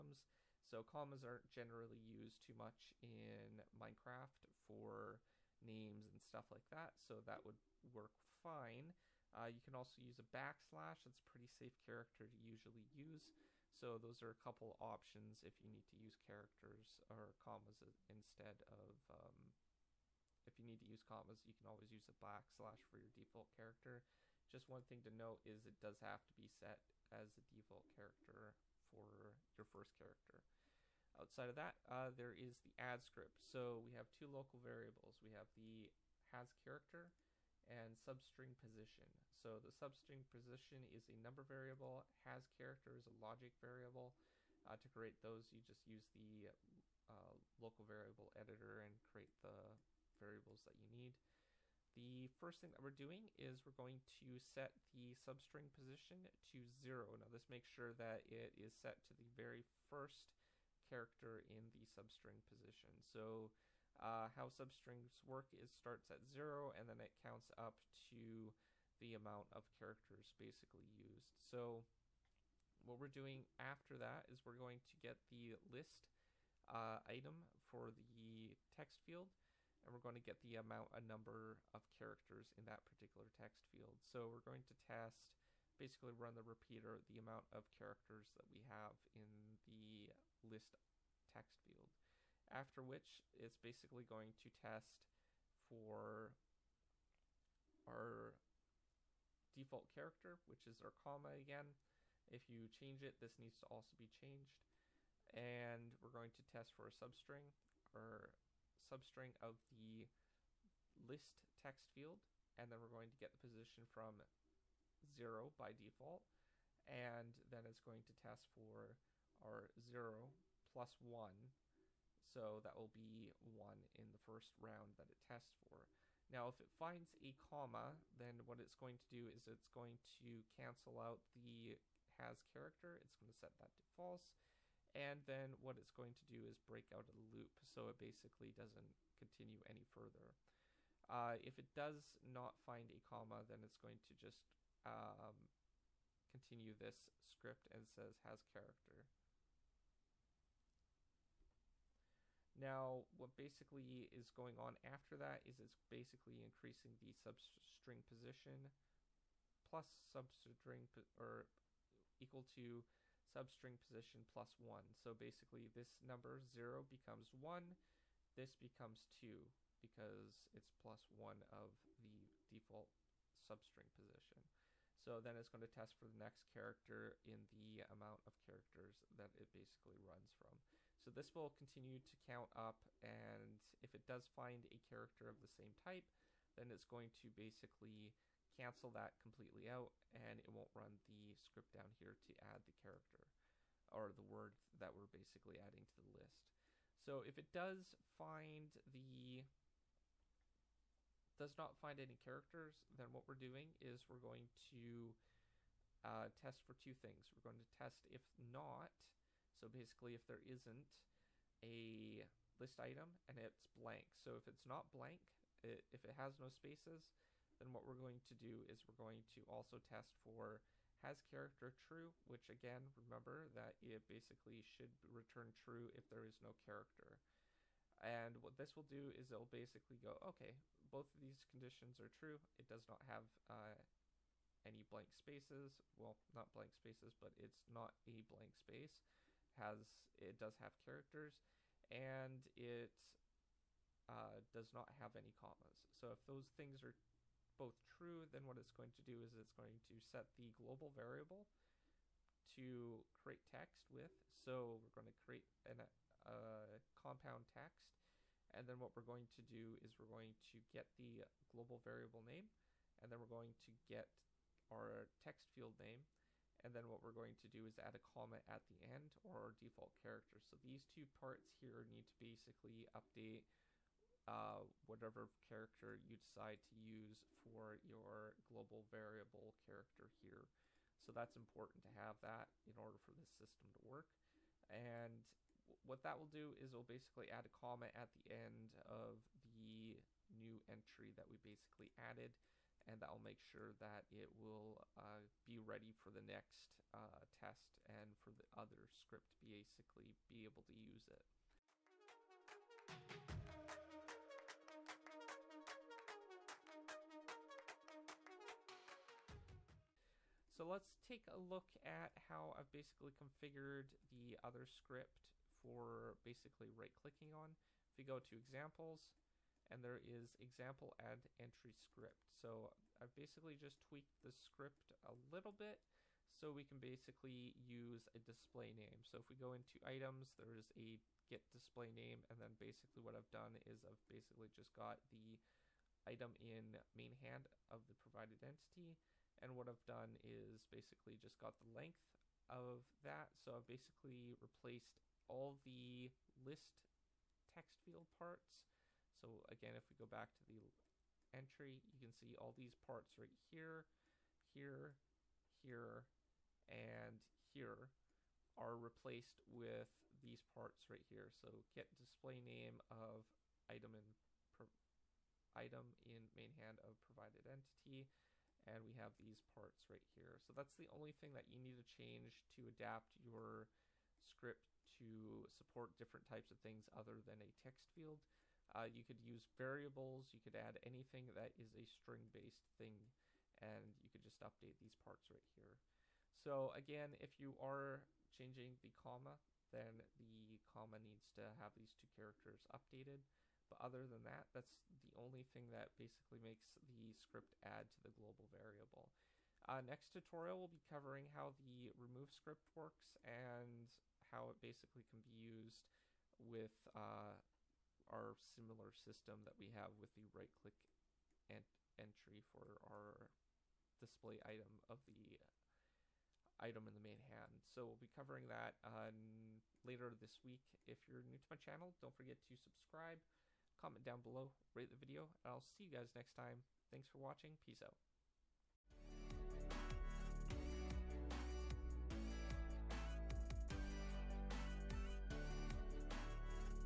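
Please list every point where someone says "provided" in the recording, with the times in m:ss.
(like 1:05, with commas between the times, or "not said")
5:37, 6:06.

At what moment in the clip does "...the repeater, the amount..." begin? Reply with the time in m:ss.
1:26.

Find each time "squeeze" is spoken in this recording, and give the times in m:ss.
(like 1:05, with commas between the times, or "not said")
not said.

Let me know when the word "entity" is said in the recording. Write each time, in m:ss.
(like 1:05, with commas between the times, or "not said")
5:38, 6:07.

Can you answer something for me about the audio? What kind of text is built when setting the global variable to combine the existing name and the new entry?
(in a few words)
Compound text.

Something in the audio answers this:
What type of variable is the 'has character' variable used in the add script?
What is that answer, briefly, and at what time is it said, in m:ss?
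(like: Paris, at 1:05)
Logic variable, at 0:43.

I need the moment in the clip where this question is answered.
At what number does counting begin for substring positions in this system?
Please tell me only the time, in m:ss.
1:05.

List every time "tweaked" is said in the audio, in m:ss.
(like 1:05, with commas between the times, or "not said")
5:23.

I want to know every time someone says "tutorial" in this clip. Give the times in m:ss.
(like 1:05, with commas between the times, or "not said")
6:40.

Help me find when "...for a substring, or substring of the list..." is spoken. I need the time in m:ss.
1:46.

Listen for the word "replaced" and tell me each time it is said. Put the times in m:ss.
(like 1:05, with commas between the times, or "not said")
5:44, 5:58.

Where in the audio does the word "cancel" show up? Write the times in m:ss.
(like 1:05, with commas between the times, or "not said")
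2:10, 3:08.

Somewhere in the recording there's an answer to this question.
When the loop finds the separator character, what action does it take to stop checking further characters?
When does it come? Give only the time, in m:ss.
2:16.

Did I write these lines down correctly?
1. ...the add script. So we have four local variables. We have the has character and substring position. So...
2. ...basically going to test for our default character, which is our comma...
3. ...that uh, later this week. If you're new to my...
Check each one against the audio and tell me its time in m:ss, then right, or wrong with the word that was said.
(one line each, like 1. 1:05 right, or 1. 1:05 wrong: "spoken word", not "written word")
1. 0:32 wrong: "two", not "four"
2. 1:33 right
3. 6:58 right.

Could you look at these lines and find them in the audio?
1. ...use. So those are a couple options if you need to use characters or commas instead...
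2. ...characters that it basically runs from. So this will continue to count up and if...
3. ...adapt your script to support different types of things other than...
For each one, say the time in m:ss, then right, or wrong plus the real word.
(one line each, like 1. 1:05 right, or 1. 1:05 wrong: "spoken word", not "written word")
1. 0:12 right
2. 2:58 right
3. 6:12 right.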